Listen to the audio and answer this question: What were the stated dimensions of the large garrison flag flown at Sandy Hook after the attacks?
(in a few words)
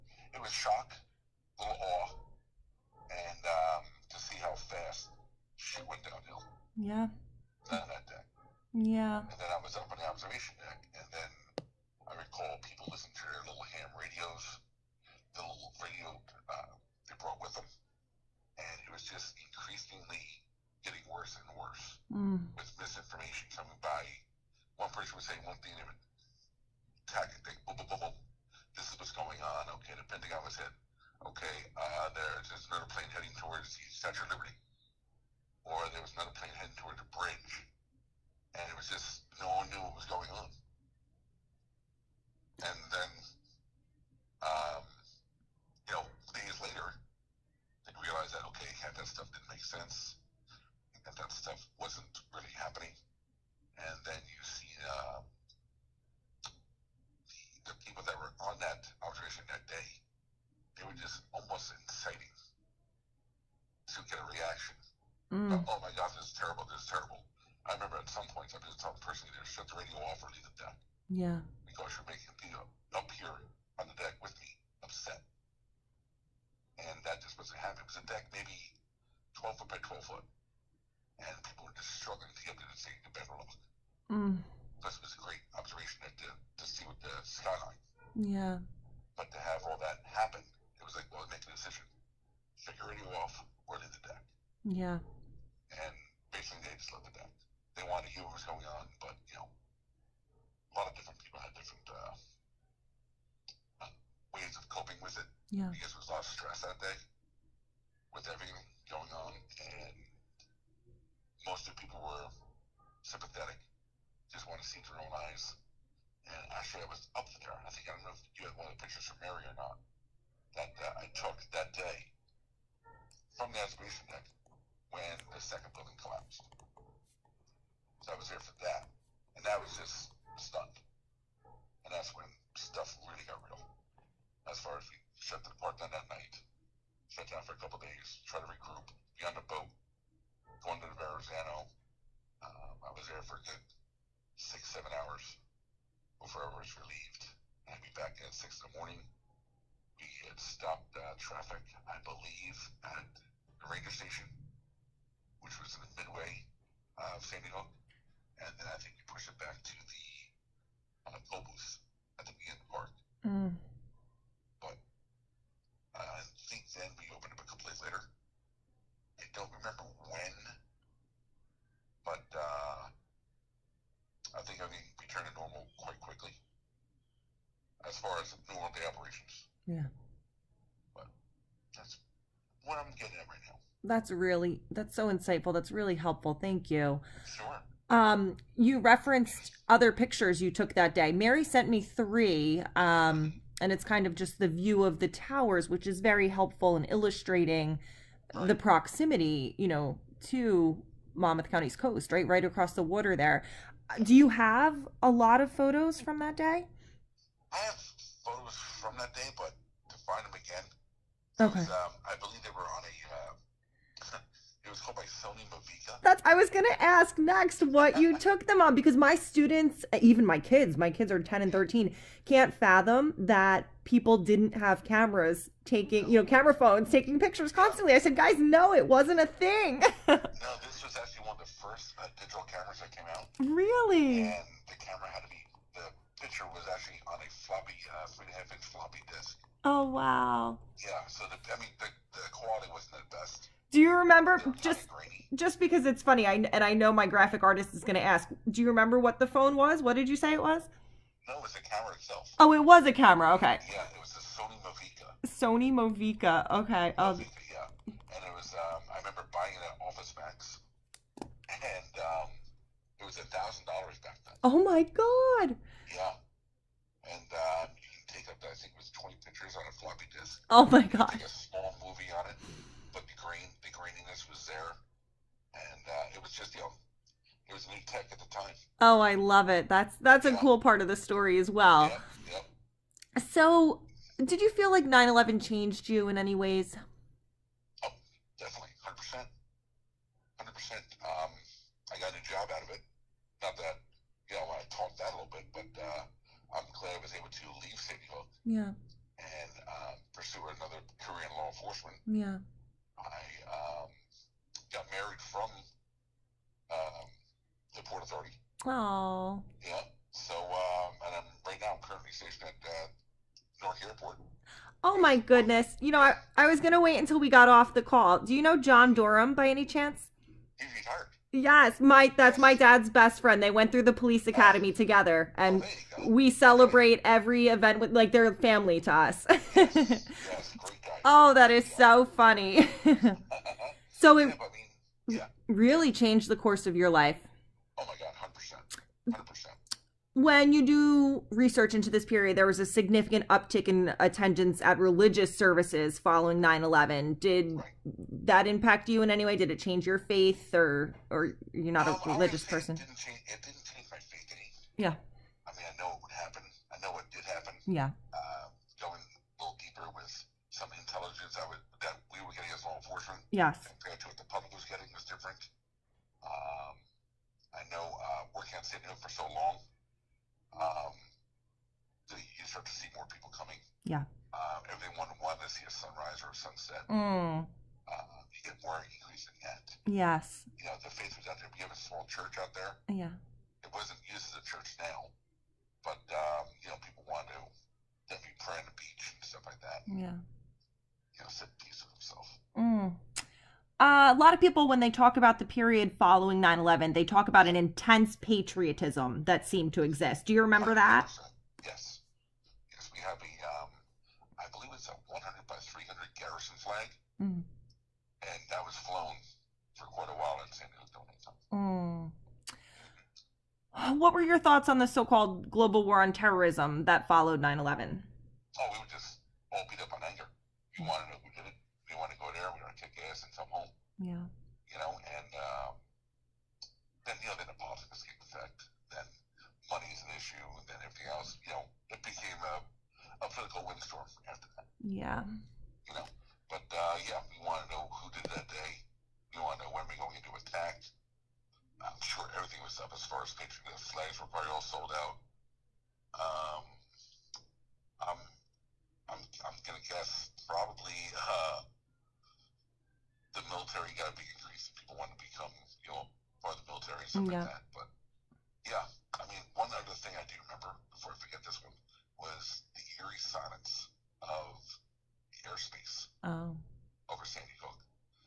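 100 by 300.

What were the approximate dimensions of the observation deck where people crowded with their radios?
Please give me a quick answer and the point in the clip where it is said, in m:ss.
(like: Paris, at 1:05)
12 foot by 12 foot, at 1:19.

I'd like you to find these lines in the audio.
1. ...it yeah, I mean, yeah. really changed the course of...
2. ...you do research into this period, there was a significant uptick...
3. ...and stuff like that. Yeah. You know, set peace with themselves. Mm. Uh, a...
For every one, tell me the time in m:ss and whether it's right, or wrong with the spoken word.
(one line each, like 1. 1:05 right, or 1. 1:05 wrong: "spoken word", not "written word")
1. 5:34 right
2. 5:40 right
3. 6:29 right.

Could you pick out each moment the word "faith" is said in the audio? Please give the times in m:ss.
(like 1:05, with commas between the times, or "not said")
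5:49, 5:54, 6:20.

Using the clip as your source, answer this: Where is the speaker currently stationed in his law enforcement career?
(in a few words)
Newark Airport.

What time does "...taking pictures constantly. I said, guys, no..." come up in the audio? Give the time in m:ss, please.
3:46.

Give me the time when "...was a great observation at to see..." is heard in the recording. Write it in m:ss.
1:25.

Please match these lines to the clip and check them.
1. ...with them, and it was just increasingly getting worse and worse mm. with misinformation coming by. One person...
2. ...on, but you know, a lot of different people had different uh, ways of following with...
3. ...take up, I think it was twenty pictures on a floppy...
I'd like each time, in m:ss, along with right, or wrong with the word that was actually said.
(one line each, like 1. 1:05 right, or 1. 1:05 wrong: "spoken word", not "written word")
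1. 0:17 right
2. 1:38 wrong: "coping", not "following"
3. 4:28 right.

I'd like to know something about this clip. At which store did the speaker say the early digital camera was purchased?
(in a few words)
Office Max.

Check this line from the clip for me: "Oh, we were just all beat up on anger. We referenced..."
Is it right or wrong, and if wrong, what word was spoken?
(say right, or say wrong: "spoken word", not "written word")
wrong: "wanted", not "referenced".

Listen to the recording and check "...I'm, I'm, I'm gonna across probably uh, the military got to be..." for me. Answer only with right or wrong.
wrong.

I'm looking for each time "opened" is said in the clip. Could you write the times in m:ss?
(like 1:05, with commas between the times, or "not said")
2:47.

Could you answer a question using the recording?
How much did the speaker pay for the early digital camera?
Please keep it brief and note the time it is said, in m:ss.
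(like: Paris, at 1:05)
$1,000, at 4:23.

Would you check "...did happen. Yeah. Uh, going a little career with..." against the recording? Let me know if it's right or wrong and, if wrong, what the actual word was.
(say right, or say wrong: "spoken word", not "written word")
wrong: "deeper", not "career".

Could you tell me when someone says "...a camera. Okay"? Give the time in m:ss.
4:12.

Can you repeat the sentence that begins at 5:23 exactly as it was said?
They went through the police oh.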